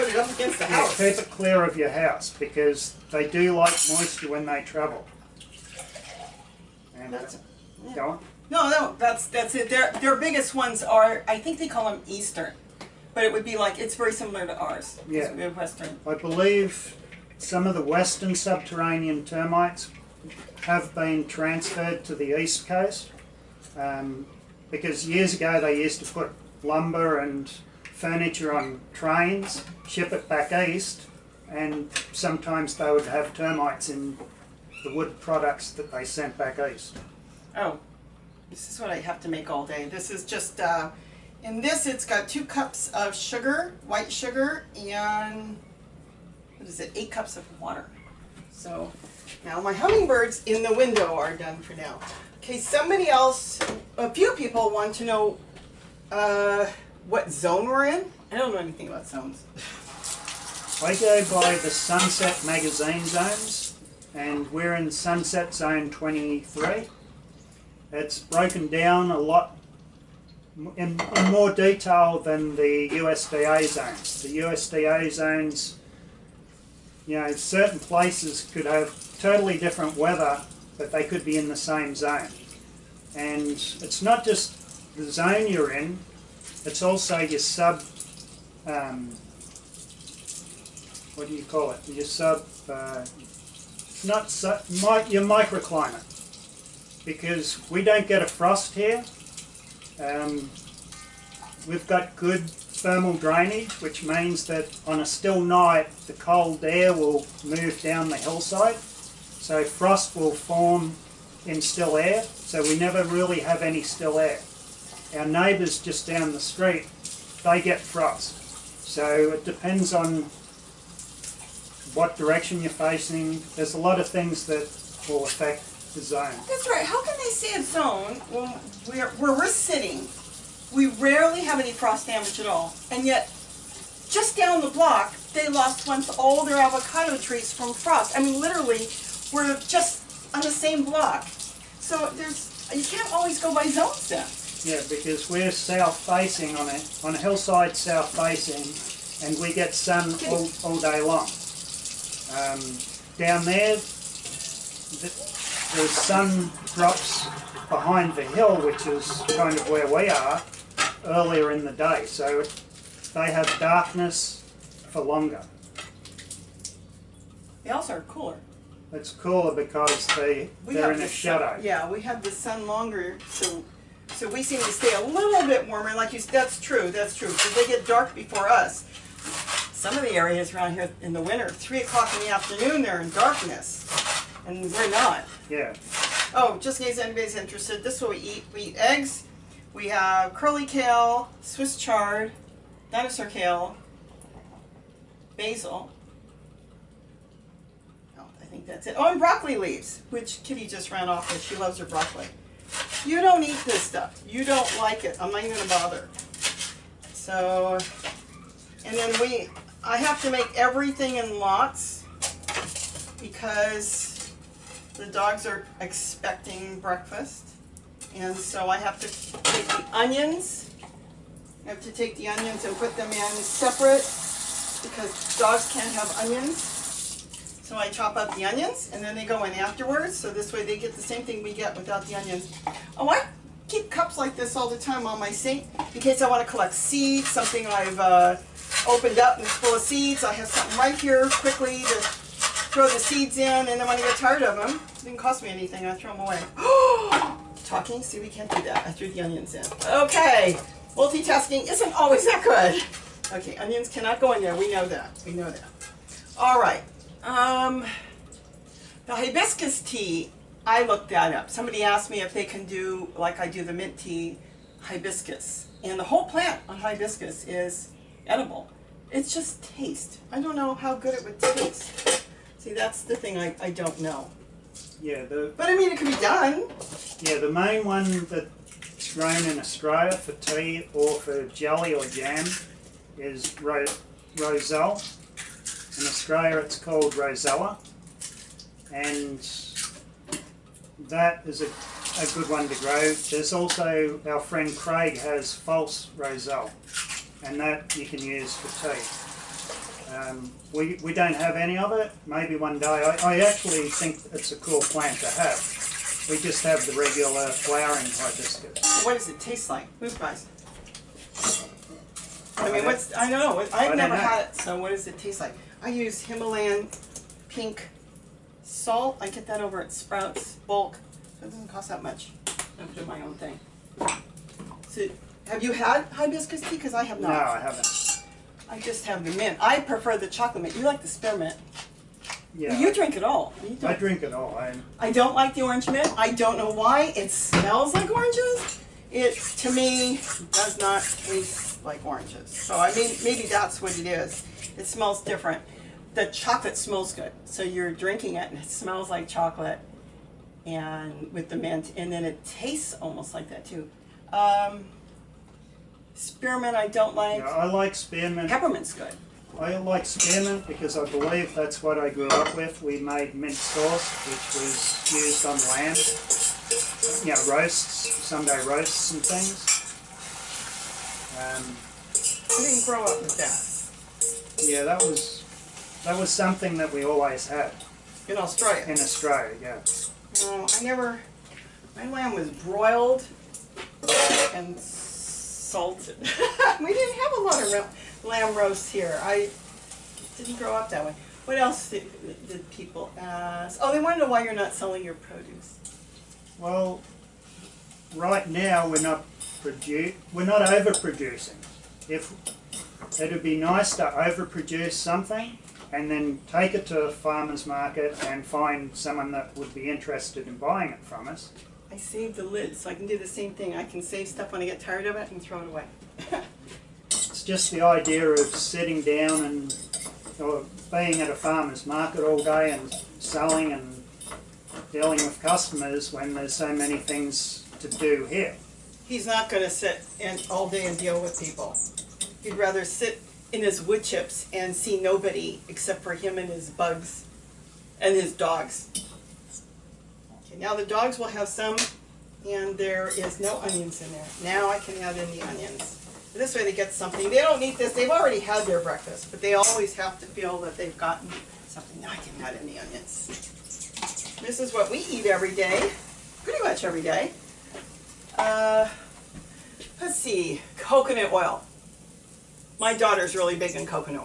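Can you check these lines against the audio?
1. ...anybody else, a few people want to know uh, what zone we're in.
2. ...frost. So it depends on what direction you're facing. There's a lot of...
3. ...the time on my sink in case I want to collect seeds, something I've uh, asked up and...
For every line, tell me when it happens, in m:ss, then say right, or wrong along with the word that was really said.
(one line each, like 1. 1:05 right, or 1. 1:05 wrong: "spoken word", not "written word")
1. 0:52 wrong: "somebody", not "anybody"
2. 1:57 right
3. 3:54 wrong: "opened", not "asked".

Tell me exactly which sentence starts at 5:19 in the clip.
I get that over at Sprouts bulk.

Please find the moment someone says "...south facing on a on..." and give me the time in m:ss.
2:25.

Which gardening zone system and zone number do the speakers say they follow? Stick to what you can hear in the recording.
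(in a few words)
Sunset Zone 23.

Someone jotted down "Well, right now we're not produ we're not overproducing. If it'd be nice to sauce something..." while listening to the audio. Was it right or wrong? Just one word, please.
wrong.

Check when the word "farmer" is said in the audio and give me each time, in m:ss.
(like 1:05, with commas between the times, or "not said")
6:47, 7:01.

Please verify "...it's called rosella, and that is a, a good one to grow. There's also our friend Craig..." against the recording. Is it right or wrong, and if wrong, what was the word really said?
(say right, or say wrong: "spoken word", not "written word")
right.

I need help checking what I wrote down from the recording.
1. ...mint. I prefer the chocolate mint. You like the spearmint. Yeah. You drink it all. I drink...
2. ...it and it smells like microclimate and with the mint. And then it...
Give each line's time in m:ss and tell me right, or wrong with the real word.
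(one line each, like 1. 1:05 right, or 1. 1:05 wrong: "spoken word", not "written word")
1. 5:29 right
2. 5:48 wrong: "chocolate", not "microclimate".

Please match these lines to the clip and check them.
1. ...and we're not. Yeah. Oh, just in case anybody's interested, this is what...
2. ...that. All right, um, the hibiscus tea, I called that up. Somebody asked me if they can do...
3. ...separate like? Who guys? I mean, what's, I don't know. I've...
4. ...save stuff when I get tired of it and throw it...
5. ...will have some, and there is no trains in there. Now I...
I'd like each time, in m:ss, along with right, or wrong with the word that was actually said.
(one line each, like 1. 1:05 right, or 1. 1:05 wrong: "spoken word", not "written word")
1. 3:04 right
2. 4:15 wrong: "looked", not "called"
3. 5:09 wrong: "taste", not "separate"
4. 6:54 right
5. 7:21 wrong: "onions", not "trains".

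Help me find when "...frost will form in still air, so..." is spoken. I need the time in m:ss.
1:49.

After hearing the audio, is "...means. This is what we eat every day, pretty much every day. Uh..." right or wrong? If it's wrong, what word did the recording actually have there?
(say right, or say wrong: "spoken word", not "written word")
wrong: "onions", not "means".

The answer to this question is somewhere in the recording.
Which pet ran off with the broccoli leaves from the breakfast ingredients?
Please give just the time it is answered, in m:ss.
3:20.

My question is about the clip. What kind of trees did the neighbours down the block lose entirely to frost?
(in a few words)
avocado trees.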